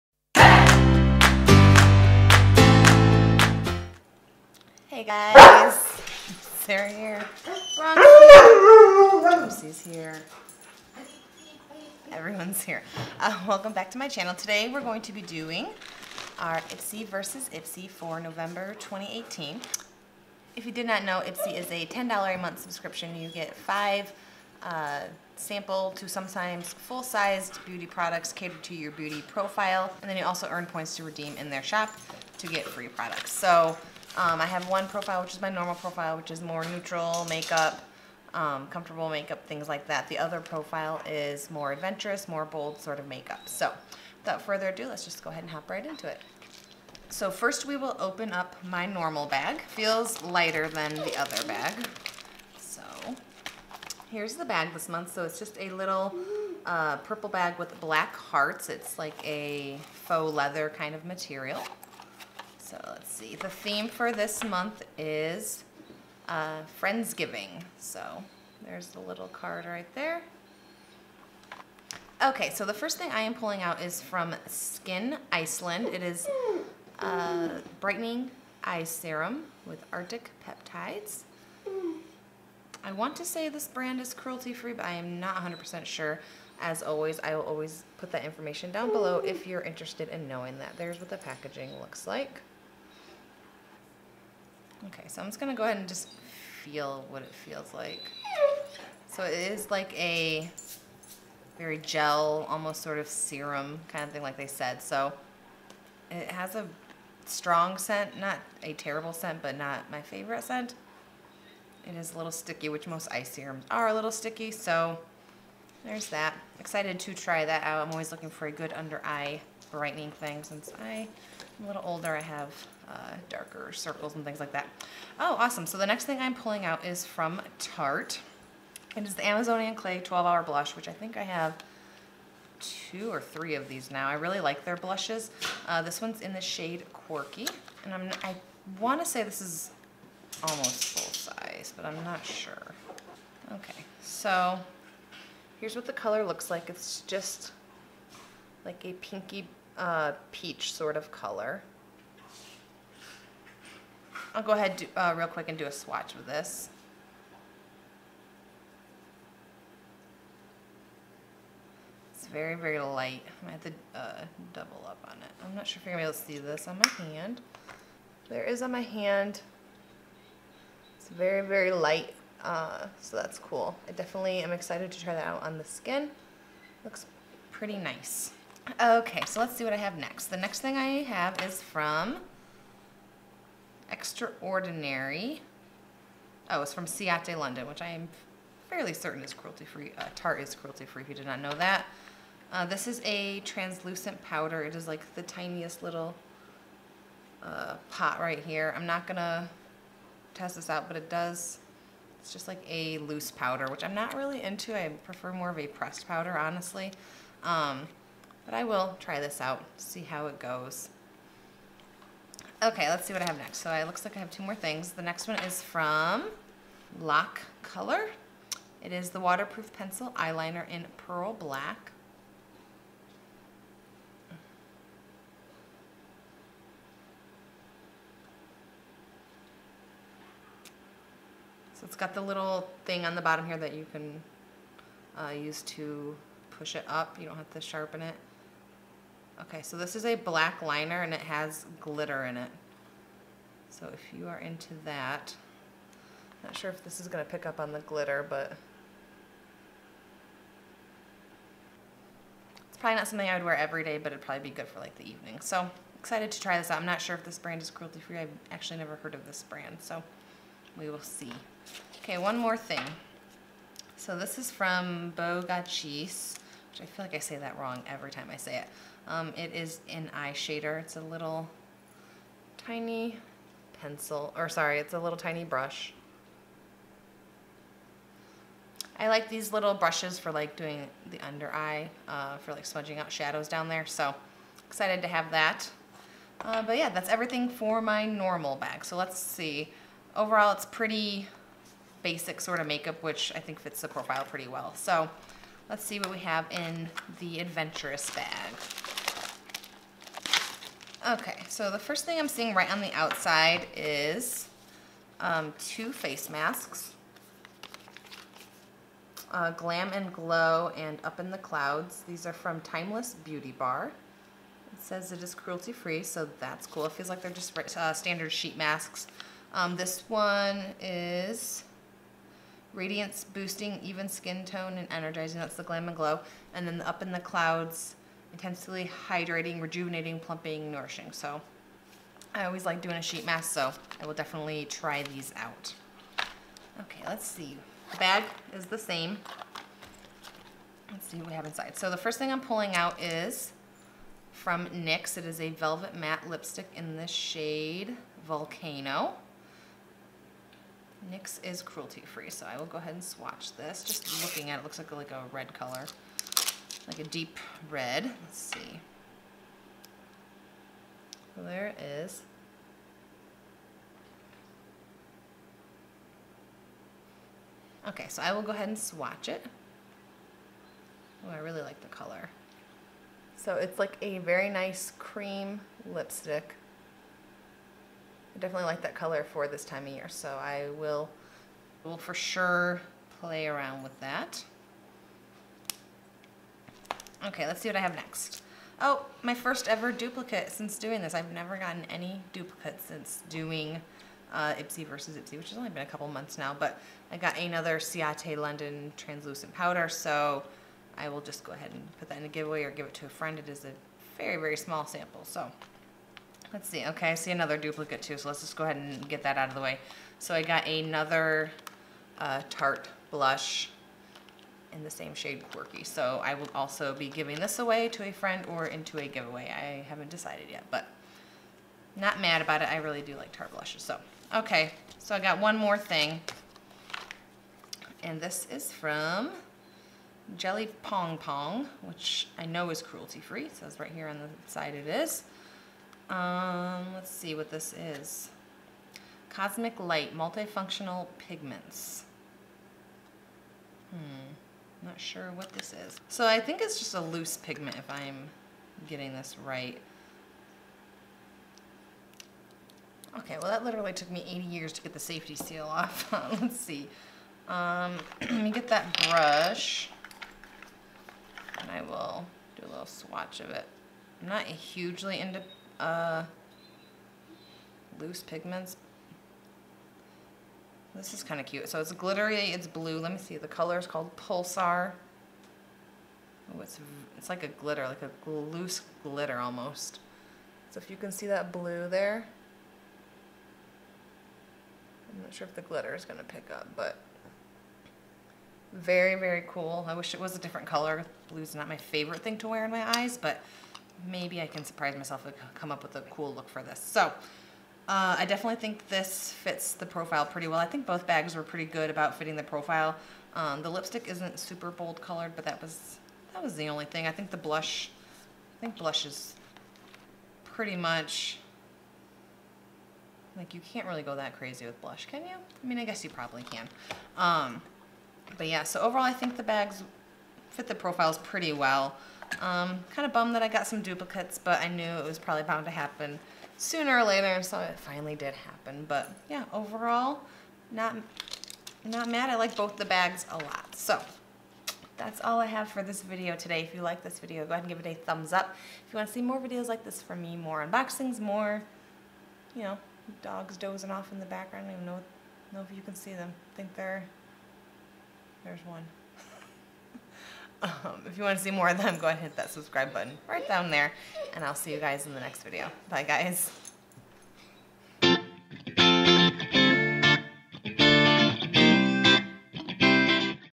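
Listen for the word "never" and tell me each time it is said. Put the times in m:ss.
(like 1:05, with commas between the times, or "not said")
4:18, 6:31.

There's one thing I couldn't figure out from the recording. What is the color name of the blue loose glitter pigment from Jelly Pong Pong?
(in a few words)
Pulsar.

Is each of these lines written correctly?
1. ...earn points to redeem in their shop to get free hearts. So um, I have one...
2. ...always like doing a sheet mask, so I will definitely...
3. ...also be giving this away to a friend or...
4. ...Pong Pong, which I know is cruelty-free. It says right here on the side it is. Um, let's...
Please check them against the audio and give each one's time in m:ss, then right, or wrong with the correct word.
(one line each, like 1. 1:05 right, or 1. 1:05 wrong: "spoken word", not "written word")
1. 0:30 wrong: "products", not "hearts"
2. 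5:32 right
3. 6:56 right
4. 7:10 right.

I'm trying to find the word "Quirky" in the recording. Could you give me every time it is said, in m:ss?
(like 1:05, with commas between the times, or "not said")
2:16, 6:55.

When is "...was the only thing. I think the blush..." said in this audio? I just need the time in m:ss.
8:26.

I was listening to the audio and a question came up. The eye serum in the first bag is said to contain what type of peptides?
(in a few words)
Arctic peptides.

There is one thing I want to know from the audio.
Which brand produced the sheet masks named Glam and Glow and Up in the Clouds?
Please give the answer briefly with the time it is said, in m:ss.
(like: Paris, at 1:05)
Timeless Beauty Bar, at 5:12.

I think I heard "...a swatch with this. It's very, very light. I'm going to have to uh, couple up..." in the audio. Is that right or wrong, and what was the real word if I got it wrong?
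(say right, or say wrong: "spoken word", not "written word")
wrong: "double", not "couple".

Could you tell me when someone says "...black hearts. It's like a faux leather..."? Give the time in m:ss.
0:57.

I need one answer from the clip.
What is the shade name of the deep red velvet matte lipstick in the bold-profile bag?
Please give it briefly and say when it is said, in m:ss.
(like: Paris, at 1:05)
Volcano, at 5:48.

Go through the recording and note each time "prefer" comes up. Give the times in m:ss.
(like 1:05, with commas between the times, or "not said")
3:24.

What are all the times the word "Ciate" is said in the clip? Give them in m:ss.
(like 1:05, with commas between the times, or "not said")
3:06, 6:37.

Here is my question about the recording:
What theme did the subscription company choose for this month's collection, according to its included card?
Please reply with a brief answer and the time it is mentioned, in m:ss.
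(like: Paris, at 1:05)
Friendsgiving, at 1:06.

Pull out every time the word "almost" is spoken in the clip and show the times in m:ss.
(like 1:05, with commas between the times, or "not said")
1:42, 2:20, 7:59.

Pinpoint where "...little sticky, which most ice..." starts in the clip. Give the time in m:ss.
1:52.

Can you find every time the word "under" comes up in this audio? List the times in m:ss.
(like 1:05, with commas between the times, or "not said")
1:58, 4:41.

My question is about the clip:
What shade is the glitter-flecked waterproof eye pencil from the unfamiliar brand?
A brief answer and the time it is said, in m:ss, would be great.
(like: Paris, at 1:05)
Pearl Black, at 3:40.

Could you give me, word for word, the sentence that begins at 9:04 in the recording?
I don't even know, know if you can see them.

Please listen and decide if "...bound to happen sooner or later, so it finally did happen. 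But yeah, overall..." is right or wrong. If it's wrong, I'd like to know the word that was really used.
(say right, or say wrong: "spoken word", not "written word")
right.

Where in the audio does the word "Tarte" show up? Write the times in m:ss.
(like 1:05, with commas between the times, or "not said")
2:07, 3:10, 6:52, 7:03.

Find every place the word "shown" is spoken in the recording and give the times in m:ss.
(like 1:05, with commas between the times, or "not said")
not said.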